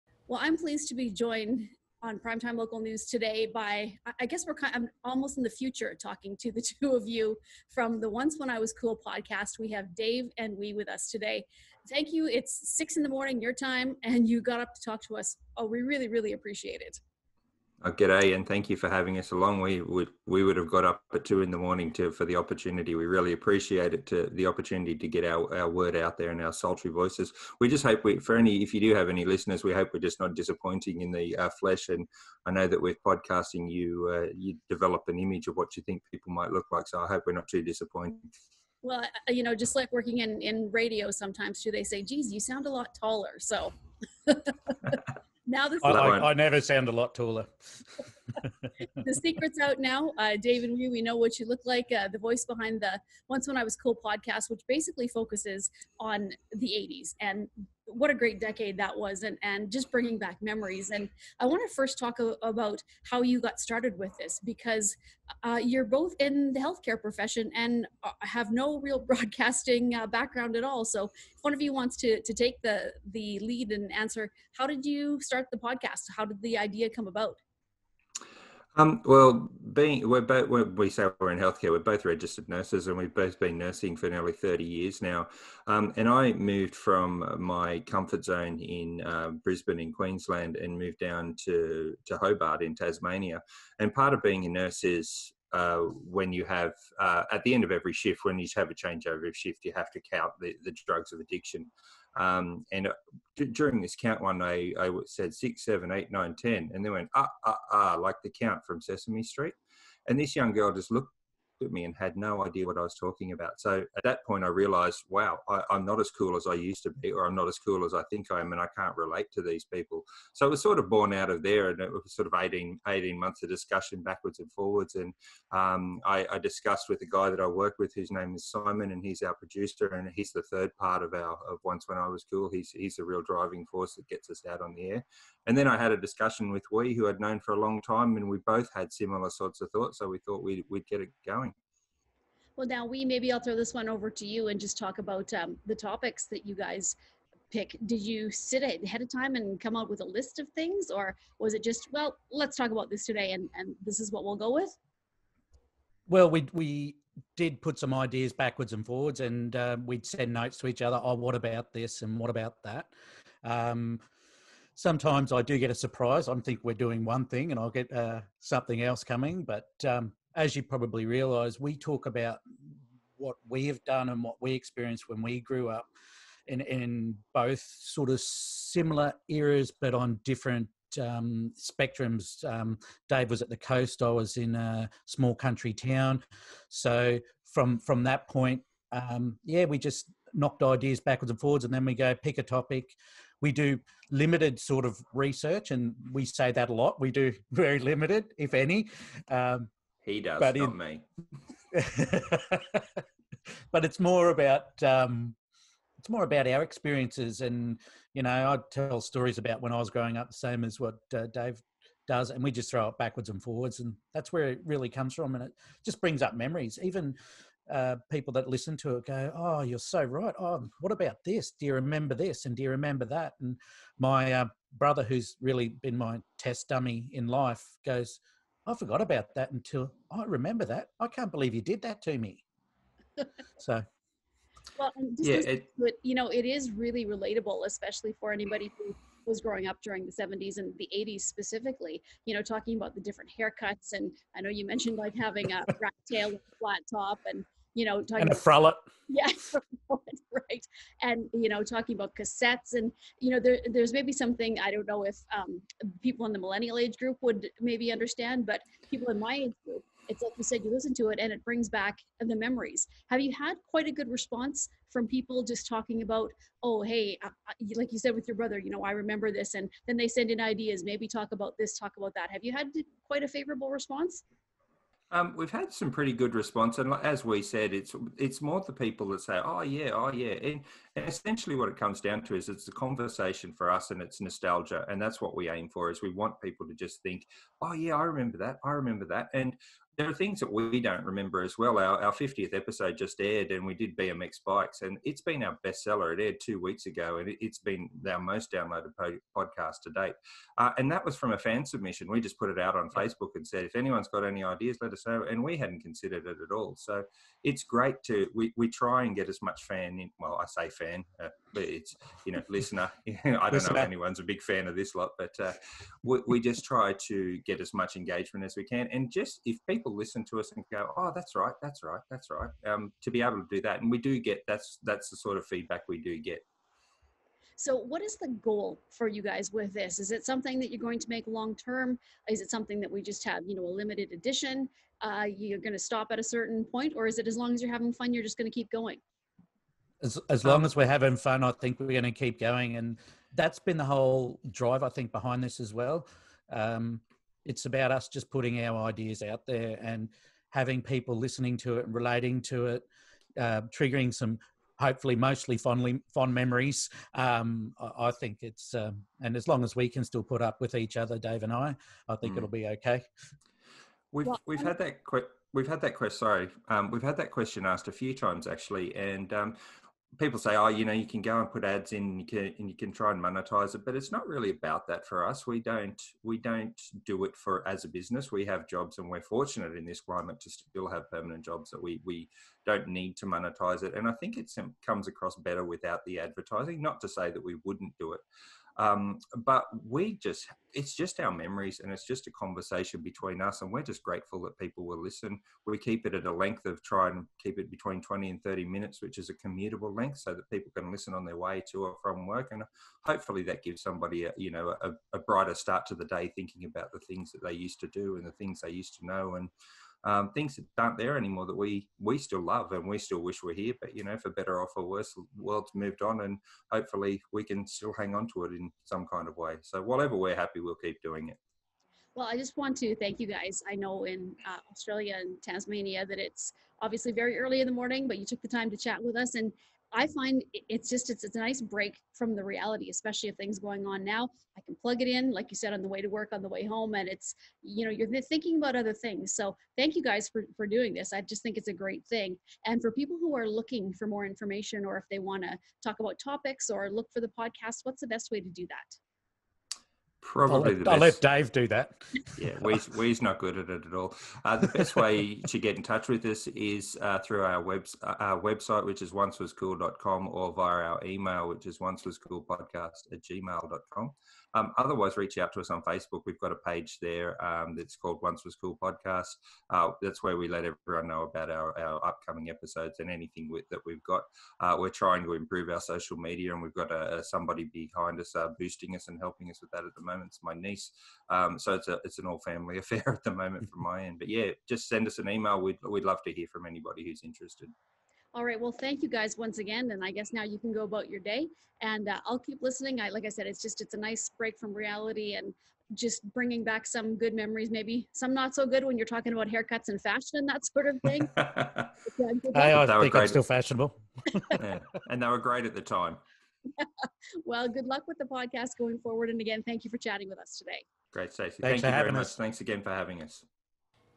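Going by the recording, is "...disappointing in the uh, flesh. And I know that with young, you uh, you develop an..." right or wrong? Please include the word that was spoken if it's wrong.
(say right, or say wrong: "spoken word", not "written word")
wrong: "podcasting", not "young".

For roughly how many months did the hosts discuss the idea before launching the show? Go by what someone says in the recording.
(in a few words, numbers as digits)
18.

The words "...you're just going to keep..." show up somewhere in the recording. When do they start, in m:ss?
5:38.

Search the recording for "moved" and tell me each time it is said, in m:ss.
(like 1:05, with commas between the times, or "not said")
1:26, 1:30, 6:55.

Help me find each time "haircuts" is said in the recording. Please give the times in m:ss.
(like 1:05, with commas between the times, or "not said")
4:03, 8:19.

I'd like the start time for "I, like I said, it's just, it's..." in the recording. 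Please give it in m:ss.
8:13.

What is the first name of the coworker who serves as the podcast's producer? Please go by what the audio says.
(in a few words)
Simon.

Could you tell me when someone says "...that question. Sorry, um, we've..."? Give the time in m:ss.
6:05.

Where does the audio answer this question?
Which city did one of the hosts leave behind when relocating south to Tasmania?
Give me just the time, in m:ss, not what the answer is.
1:29.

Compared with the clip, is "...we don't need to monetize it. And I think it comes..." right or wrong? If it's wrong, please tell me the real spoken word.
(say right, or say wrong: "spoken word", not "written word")
right.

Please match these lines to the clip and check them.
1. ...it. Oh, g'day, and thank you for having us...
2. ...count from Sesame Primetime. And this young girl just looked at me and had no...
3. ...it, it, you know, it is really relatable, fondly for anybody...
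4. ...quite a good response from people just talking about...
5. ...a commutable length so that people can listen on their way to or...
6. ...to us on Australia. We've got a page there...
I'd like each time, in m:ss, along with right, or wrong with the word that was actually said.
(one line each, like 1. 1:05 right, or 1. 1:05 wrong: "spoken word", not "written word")
1. 0:16 right
2. 1:48 wrong: "Street", not "Primetime"
3. 3:55 wrong: "especially", not "fondly"
4. 4:23 right
5. 6:39 right
6. 7:45 wrong: "Facebook", not "Australia".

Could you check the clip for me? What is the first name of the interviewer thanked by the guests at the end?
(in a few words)
Stacey.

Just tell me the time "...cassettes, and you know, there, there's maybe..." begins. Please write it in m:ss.
4:12.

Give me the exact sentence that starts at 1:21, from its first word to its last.
We're both registered nurses, and we've both been nursing for nearly thirty years now.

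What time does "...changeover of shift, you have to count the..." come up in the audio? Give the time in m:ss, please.
1:38.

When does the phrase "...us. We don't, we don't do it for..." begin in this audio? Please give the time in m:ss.
6:15.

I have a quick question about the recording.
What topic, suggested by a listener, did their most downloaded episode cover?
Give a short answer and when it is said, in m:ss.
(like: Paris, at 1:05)
BMX bikes, at 4:53.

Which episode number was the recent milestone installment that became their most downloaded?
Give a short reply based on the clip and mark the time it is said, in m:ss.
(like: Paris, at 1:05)
50th, at 4:52.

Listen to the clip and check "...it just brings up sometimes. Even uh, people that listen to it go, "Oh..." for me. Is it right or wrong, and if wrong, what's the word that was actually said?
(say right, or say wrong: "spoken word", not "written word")
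wrong: "memories", not "sometimes".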